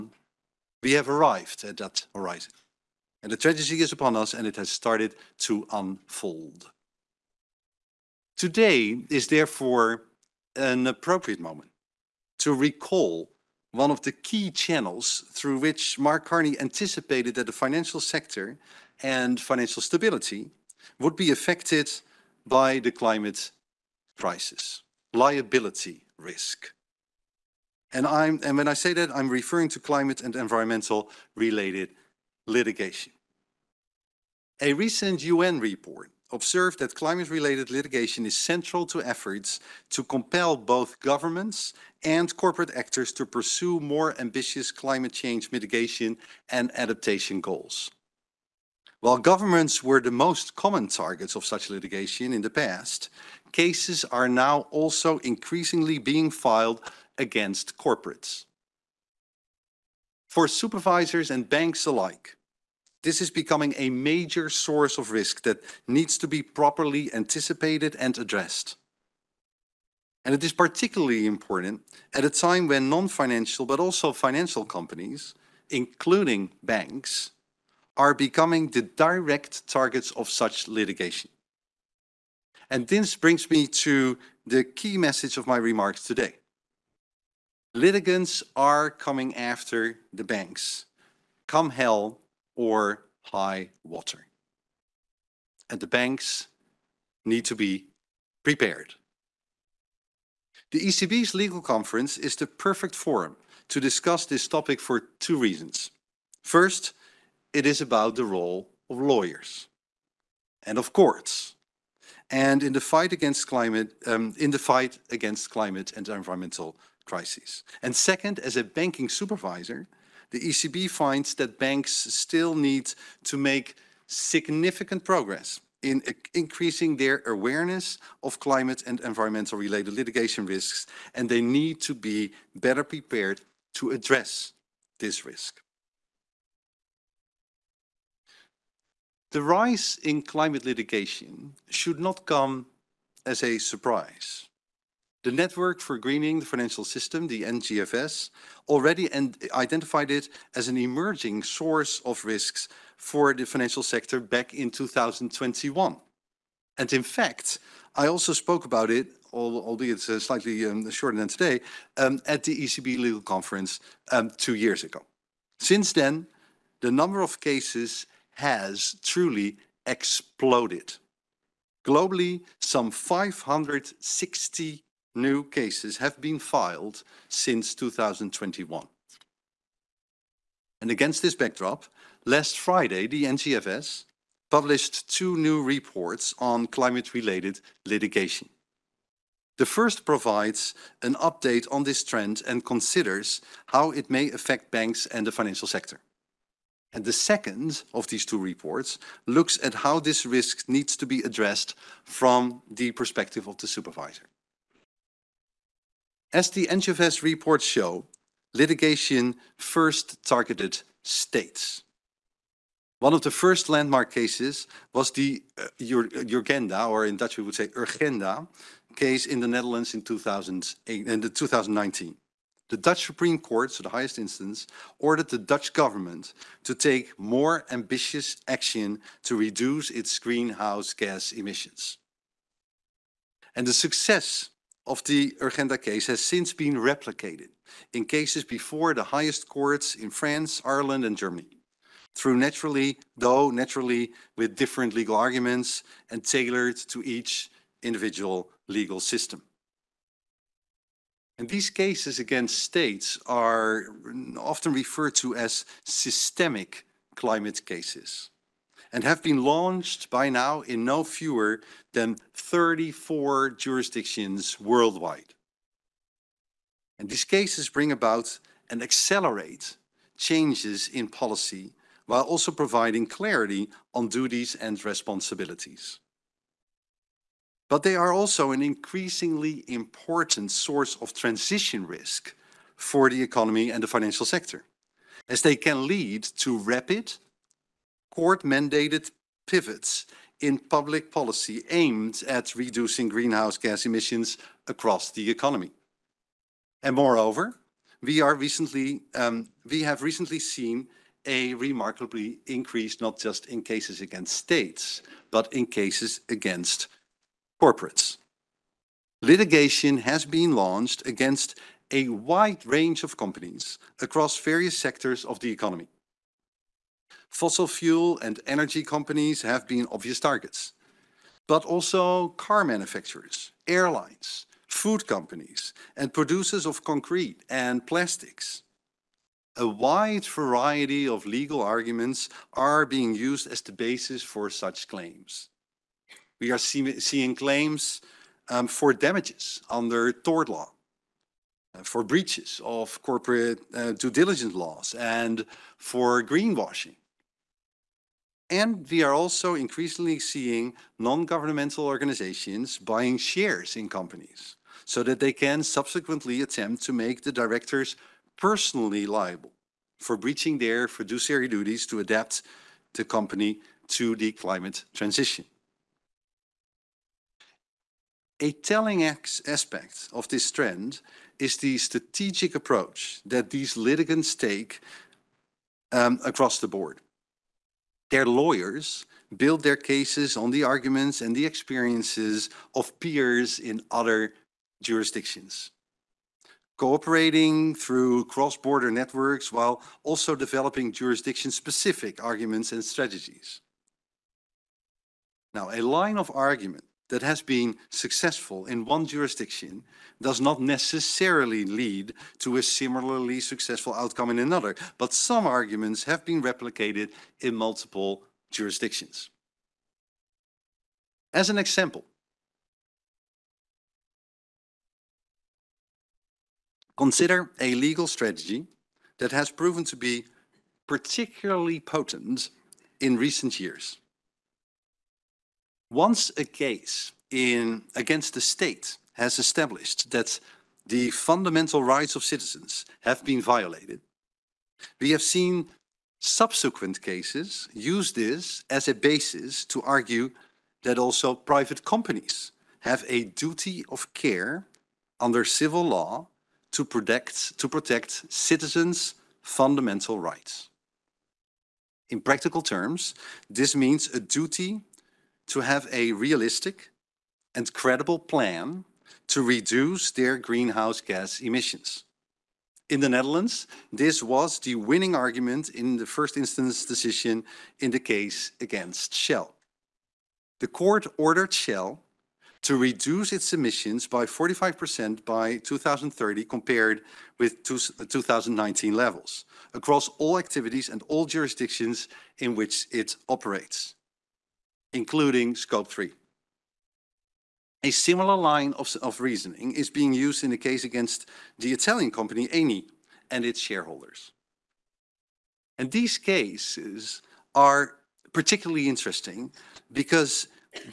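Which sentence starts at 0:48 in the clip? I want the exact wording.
While governments were the most common targets of such litigation in the past, cases are now also increasingly being filed against corporates.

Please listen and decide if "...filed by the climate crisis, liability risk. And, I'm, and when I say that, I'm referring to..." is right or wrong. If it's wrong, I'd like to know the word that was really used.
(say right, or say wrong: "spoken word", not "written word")
wrong: "affected", not "filed".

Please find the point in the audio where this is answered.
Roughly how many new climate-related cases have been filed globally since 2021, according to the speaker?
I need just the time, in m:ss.
2:52.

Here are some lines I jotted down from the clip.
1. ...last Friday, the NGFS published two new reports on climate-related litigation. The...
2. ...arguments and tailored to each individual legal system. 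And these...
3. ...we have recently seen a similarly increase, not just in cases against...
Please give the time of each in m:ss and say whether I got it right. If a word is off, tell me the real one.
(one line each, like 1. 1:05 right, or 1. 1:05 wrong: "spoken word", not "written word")
1. 3:02 right
2. 4:05 right
3. 4:59 wrong: "remarkably", not "similarly".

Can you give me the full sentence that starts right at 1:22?
and This brings me to the key message of my remarks today.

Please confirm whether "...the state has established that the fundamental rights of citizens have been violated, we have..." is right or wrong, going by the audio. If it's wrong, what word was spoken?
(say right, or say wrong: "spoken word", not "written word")
right.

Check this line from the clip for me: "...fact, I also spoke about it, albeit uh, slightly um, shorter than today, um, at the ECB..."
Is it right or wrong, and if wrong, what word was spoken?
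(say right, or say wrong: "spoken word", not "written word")
right.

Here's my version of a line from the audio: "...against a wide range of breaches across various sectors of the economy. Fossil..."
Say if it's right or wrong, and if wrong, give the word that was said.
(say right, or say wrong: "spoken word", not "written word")
wrong: "companies", not "breaches".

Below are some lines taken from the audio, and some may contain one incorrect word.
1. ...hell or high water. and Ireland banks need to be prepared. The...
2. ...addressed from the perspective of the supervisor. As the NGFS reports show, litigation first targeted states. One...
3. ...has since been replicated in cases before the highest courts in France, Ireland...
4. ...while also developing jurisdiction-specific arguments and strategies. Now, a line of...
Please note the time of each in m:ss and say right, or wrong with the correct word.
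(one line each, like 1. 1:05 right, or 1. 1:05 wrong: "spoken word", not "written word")
1. 1:31 wrong: "The", not "Ireland"
2. 3:21 right
3. 3:56 right
4. 6:29 right.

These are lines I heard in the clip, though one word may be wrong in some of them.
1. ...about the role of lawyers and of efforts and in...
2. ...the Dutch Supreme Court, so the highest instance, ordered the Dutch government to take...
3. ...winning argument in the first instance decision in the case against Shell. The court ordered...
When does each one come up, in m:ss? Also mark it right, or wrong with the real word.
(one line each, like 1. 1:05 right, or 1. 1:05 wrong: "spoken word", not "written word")
1. 1:47 wrong: "courts", not "efforts"
2. 3:42 right
3. 7:44 right.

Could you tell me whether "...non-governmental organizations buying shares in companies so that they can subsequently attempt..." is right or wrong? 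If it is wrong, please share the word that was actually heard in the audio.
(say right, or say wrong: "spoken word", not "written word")
right.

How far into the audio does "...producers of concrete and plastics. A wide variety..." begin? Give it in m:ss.
5:26.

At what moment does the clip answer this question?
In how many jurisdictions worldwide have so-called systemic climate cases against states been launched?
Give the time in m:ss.
4:22.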